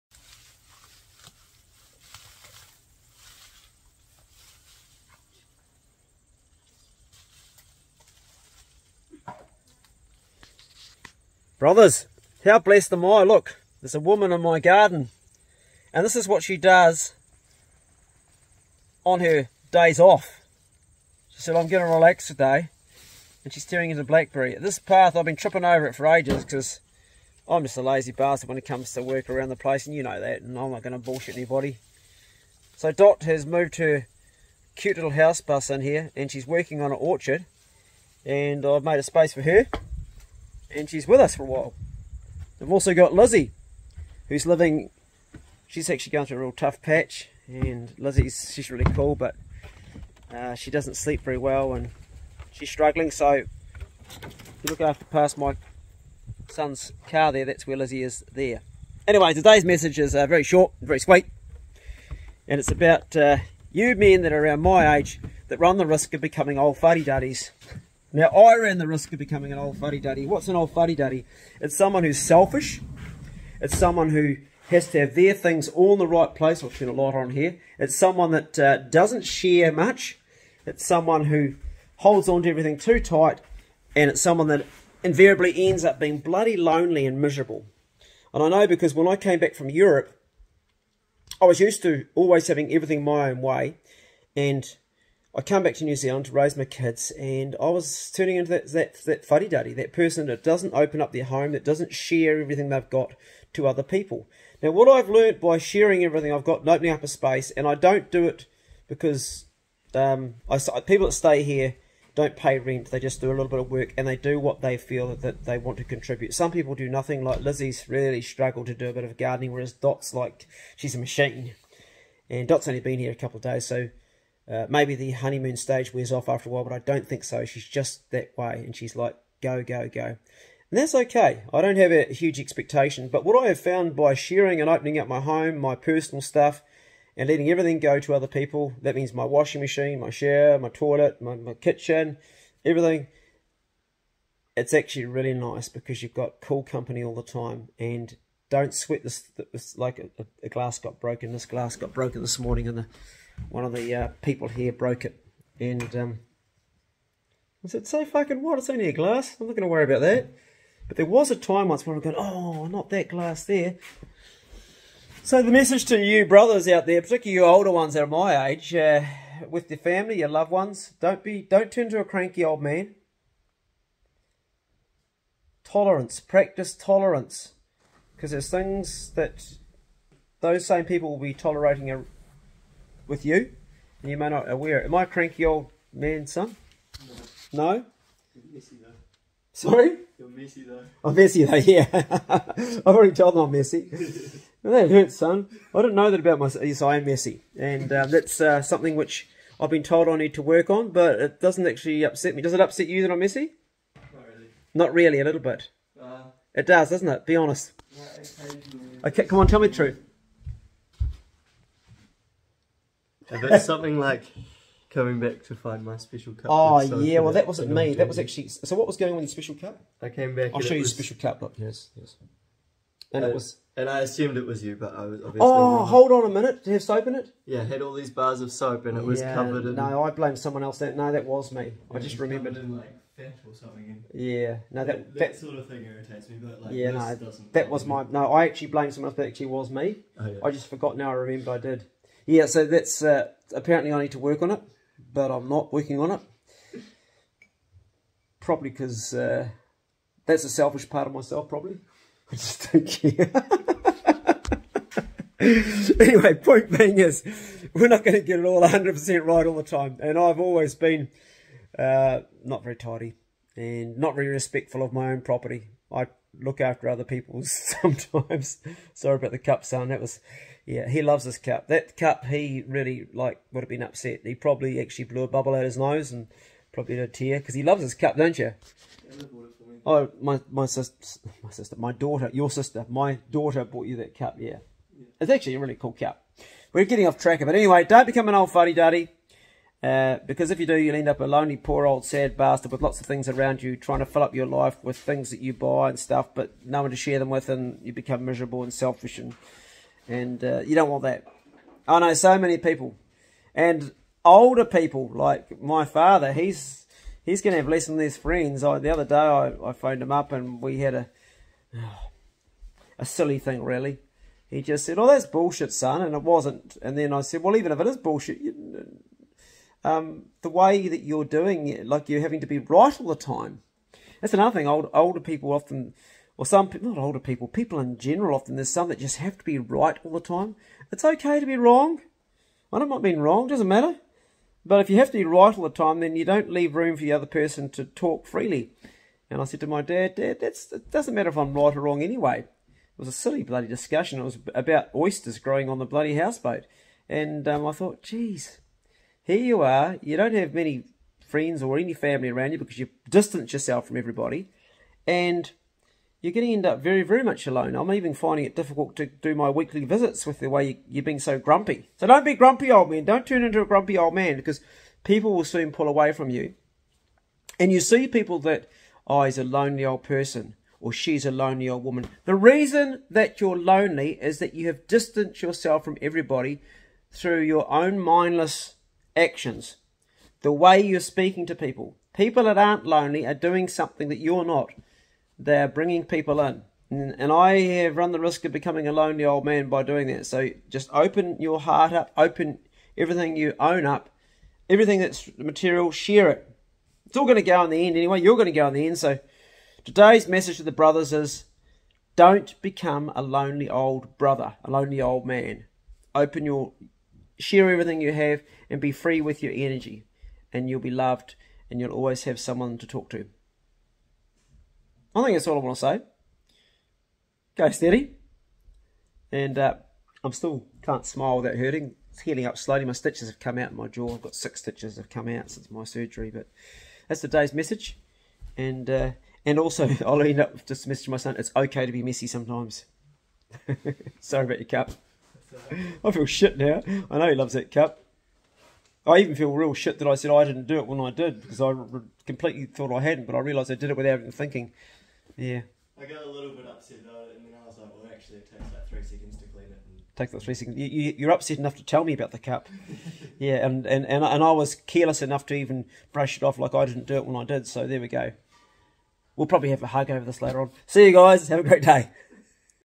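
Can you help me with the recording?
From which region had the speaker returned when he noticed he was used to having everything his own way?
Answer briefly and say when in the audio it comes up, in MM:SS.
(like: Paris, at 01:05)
Europe, at 01:29.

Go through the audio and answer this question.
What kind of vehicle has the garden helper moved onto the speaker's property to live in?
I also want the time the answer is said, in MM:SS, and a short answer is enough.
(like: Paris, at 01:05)
house bus, at 00:35.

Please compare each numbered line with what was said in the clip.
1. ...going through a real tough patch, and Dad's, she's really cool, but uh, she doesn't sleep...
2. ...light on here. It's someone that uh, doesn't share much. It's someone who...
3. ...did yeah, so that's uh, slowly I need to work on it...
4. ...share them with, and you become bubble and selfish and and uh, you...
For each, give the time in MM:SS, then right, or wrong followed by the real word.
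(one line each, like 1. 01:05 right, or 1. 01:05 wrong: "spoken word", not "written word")
1. 00:46 wrong: "Lizzie", not "Dad"
2. 01:16 right
3. 04:01 wrong: "apparently", not "slowly"
4. 04:56 wrong: "miserable", not "bubble".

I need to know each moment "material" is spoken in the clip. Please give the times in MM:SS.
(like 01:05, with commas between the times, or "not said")
06:35.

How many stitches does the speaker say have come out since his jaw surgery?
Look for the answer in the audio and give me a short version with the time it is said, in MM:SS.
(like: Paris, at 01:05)
6, at 07:04.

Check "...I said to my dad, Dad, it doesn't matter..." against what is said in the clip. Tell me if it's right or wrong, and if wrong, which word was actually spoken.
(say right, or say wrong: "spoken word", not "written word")
right.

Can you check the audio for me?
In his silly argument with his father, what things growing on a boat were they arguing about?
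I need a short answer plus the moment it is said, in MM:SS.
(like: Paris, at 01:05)
Oysters, at 05:44.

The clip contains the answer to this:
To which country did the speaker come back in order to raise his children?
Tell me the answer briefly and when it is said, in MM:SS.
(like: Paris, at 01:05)
New Zealand, at 01:35.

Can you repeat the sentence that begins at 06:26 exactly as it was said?
And I have run the risk of becoming a lonely old man by doing that.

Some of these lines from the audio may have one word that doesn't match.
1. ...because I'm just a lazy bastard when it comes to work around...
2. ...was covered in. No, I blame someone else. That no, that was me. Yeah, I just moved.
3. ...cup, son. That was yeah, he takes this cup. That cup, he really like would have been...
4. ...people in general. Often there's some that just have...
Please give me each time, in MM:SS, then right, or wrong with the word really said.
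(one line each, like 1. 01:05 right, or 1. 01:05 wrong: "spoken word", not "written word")
1. 00:26 right
2. 03:49 wrong: "remembered", not "moved"
3. 04:29 wrong: "loves", not "takes"
4. 05:27 right.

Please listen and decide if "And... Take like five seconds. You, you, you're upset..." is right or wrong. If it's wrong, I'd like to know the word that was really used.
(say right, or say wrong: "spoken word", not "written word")
wrong: "three", not "five".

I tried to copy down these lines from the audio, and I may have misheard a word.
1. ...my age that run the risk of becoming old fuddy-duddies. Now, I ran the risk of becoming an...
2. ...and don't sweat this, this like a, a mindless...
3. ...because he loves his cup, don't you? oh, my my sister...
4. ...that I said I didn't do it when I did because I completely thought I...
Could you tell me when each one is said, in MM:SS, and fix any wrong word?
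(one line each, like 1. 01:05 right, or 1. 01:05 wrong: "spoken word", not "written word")
1. 01:04 right
2. 02:27 wrong: "glass", not "mindless"
3. 04:37 right
4. 07:19 right.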